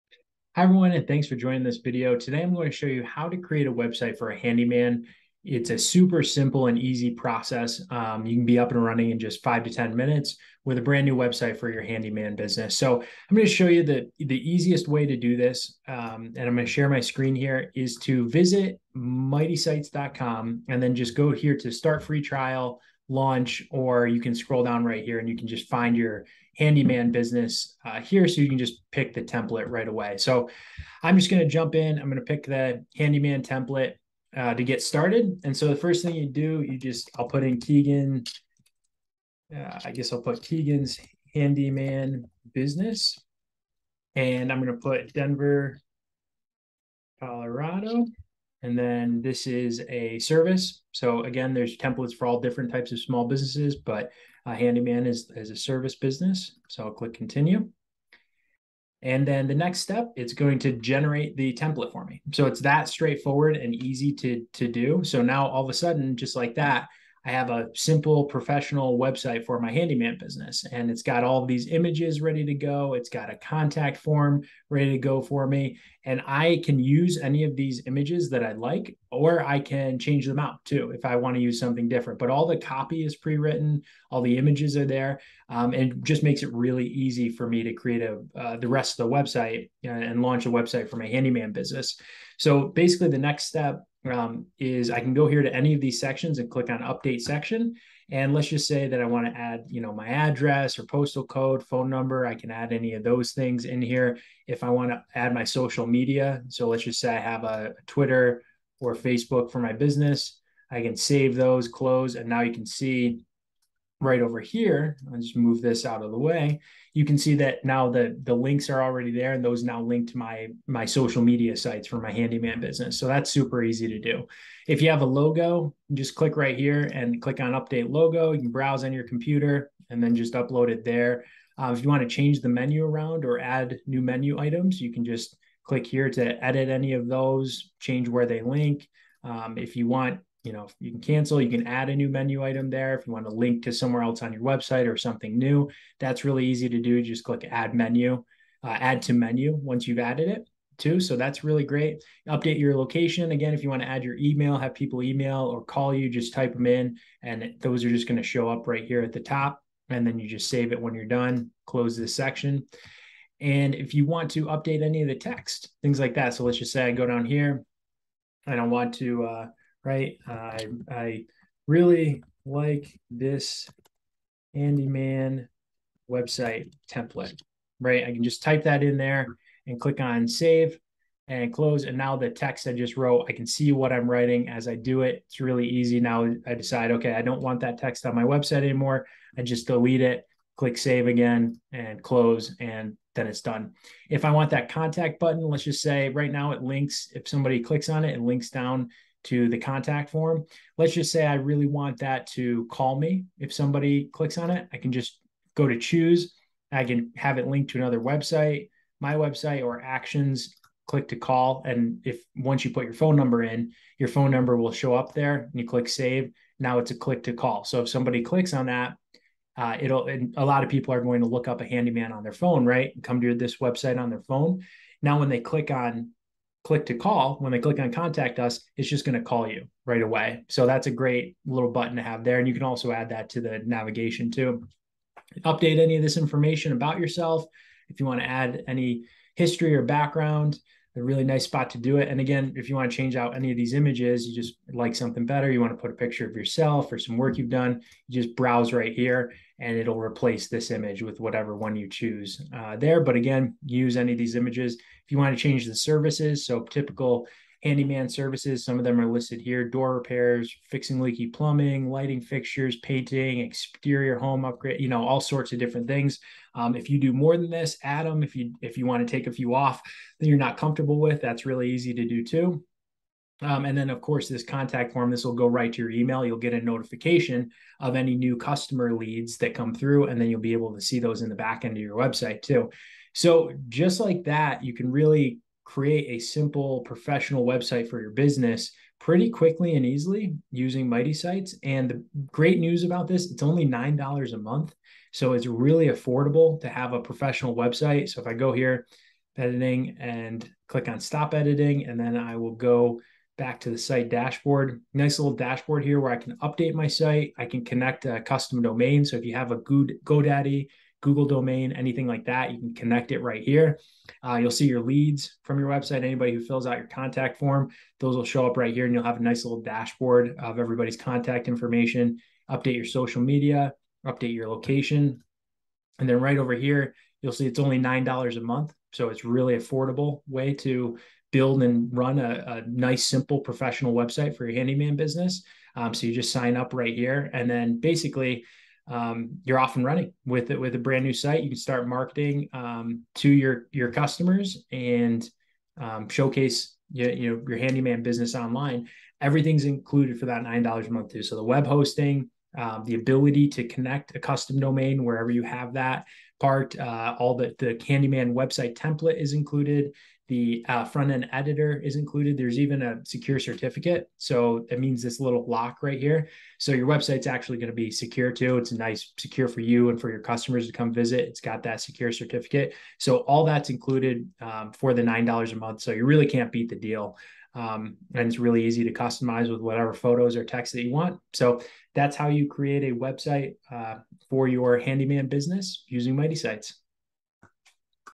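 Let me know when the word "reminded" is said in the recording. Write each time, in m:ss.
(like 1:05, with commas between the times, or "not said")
not said.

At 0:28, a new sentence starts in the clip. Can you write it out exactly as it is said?
So you can just pick the template right away.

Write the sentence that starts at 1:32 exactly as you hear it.
So basically, the next step um, is I can go here to any of these sections and click on update section.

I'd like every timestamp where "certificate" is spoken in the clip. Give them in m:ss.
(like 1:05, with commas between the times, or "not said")
6:03, 6:12.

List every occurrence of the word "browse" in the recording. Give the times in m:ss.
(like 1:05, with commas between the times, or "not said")
2:08, 4:08.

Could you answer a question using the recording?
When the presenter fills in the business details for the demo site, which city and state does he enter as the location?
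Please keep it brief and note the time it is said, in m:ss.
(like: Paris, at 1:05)
Denver, Colorado, at 0:45.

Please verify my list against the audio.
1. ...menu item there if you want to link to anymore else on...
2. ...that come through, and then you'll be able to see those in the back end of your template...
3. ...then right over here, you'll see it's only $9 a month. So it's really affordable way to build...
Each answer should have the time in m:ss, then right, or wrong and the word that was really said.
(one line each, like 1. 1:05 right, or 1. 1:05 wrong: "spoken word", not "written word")
1. 2:22 wrong: "somewhere", not "anymore"
2. 4:39 wrong: "website", not "template"
3. 5:26 right.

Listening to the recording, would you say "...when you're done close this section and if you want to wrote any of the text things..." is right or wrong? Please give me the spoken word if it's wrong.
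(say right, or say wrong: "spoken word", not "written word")
wrong: "update", not "wrote".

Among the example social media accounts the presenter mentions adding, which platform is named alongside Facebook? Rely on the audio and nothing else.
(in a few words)
Twitter.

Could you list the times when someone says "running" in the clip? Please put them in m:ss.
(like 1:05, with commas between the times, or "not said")
0:08, 5:39.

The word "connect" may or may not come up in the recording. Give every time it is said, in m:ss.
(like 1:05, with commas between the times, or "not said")
5:07, 5:12, 5:53.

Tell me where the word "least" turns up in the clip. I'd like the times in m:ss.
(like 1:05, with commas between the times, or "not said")
not said.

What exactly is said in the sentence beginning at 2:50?
Uh, I, I really like this handyman website template, right?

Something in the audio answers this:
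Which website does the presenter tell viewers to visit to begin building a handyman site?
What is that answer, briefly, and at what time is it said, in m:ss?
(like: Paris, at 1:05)
mightysites.com, at 0:18.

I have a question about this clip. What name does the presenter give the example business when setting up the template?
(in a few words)
Keegan's handyman business.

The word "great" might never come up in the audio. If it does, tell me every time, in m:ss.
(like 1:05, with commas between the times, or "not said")
2:31, 3:50, 4:52.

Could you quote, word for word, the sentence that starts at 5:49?
Everything's included for that nine dollars a month too.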